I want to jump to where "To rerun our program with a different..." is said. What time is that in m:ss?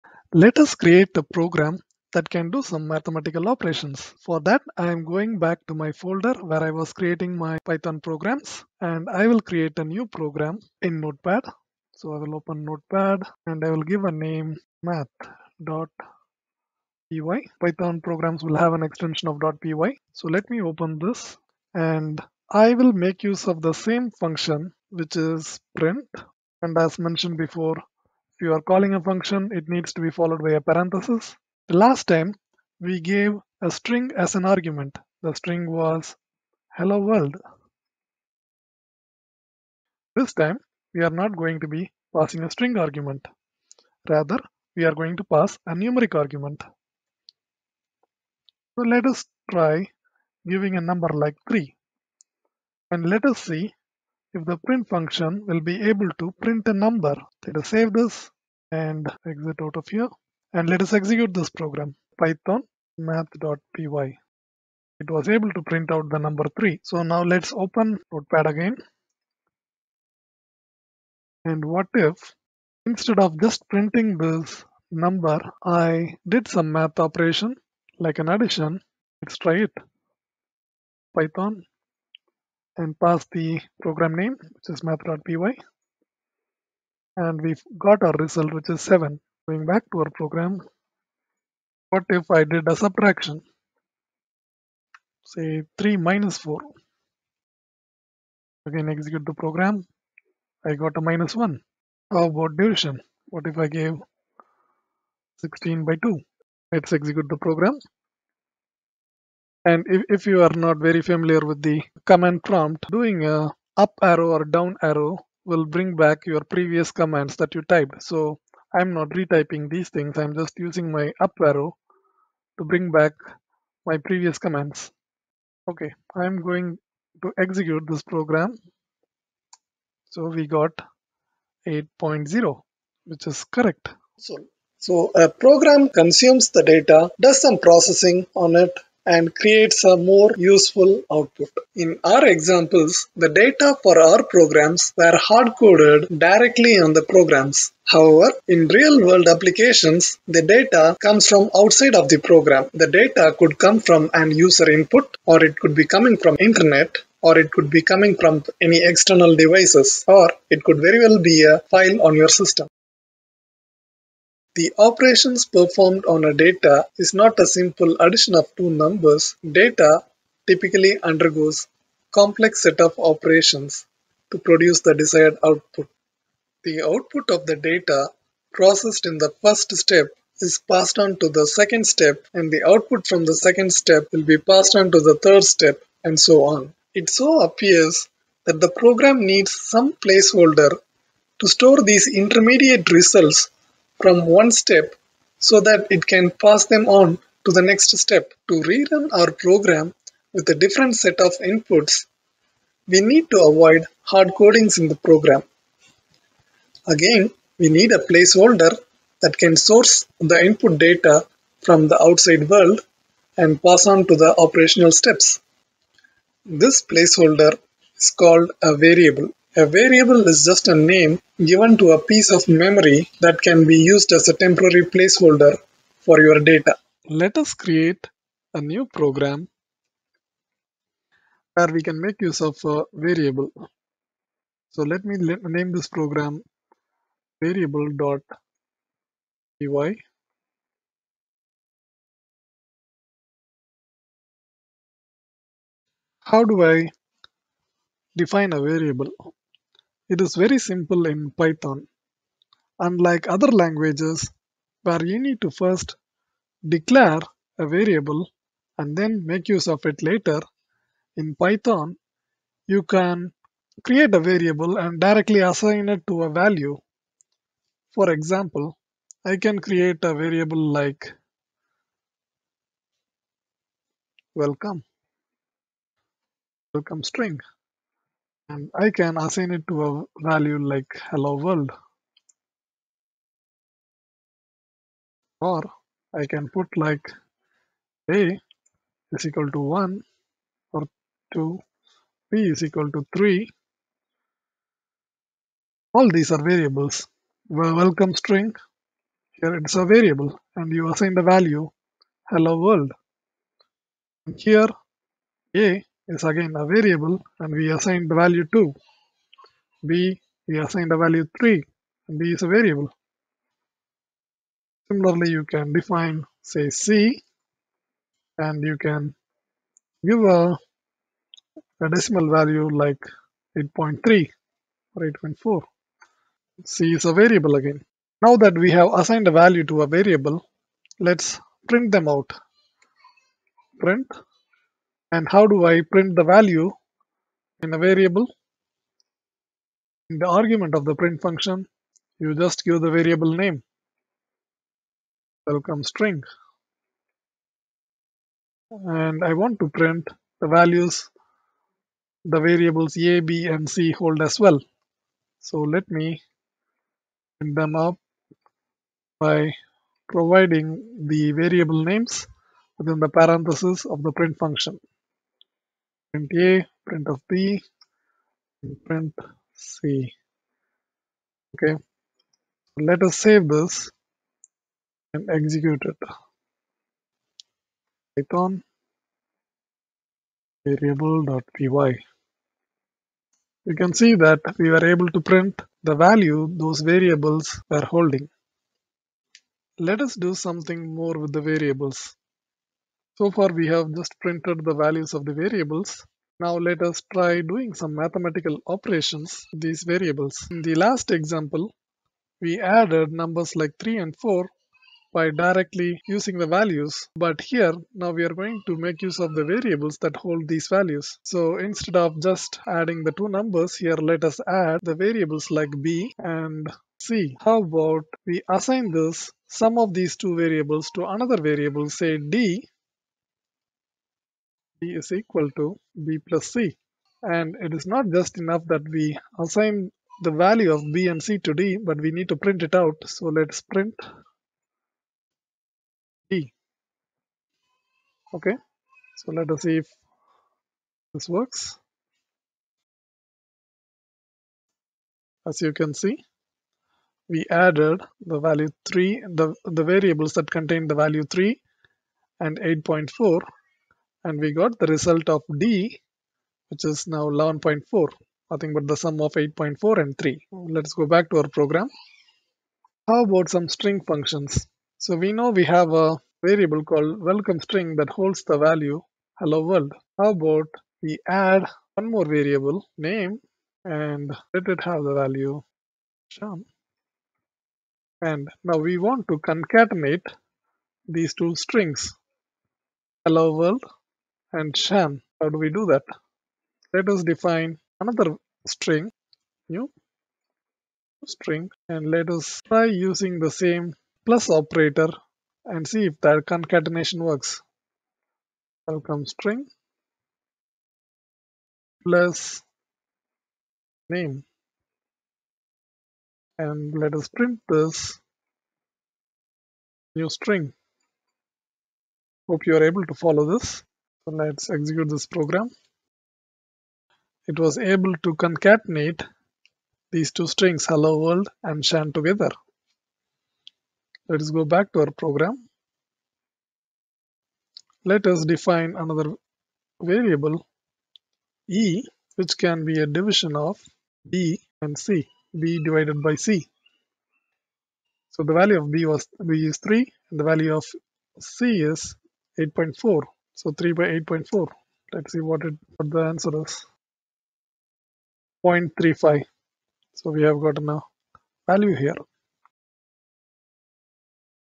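3:18.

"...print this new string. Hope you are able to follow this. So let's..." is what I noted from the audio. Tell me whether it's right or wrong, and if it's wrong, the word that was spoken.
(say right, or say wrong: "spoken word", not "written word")
right.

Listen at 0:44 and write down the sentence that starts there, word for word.
Rather, we are going to pass a numeric argument.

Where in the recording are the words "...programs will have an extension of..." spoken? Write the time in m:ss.
0:17.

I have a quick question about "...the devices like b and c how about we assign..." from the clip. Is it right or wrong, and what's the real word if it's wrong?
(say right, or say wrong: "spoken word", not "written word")
wrong: "variables", not "devices".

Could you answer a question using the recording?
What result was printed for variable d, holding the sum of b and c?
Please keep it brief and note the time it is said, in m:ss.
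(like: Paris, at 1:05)
11.4, at 7:37.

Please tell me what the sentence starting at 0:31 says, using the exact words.
The last time, we gave a string as an argument.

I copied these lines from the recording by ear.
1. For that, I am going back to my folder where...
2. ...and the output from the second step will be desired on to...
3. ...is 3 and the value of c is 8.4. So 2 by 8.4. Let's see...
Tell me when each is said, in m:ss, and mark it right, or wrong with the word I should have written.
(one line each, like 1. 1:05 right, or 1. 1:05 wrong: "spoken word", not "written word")
1. 0:04 right
2. 3:02 wrong: "passed", not "desired"
3. 8:59 wrong: "3", not "2".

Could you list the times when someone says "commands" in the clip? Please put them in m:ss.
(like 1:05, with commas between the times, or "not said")
1:52, 1:56, 2:04.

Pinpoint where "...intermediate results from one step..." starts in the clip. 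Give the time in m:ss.
3:12.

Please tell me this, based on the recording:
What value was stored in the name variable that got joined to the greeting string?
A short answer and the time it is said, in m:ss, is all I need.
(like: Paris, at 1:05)
Sean, at 7:56.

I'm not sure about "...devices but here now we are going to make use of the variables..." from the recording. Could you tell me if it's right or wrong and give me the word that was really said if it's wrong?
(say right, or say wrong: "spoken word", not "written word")
wrong: "values", not "devices".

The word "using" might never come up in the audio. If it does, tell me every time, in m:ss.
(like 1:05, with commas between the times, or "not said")
2:00, 6:46, 8:12.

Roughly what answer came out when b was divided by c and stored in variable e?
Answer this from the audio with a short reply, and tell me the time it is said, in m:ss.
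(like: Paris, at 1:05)
0.35, at 9:08.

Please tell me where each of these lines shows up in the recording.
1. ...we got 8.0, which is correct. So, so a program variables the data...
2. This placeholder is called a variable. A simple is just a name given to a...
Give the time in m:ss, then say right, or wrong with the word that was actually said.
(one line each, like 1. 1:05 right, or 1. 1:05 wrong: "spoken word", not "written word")
1. 2:10 wrong: "consumes", not "variables"
2. 3:36 wrong: "variable", not "simple".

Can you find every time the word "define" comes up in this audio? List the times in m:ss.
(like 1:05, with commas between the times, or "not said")
4:08, 5:15, 8:07, 8:48.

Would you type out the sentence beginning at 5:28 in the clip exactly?
Now that we have assigned a value to a variable, let's print them out.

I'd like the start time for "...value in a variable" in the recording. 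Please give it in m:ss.
5:36.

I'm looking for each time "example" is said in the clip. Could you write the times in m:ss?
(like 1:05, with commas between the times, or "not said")
2:22, 4:28, 6:41.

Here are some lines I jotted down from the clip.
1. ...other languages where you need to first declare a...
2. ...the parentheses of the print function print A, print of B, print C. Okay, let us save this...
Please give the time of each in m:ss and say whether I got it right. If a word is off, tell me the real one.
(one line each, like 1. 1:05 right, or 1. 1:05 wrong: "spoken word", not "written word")
1. 4:13 right
2. 6:02 right.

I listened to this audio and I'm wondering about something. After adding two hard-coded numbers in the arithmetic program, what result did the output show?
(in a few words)
7.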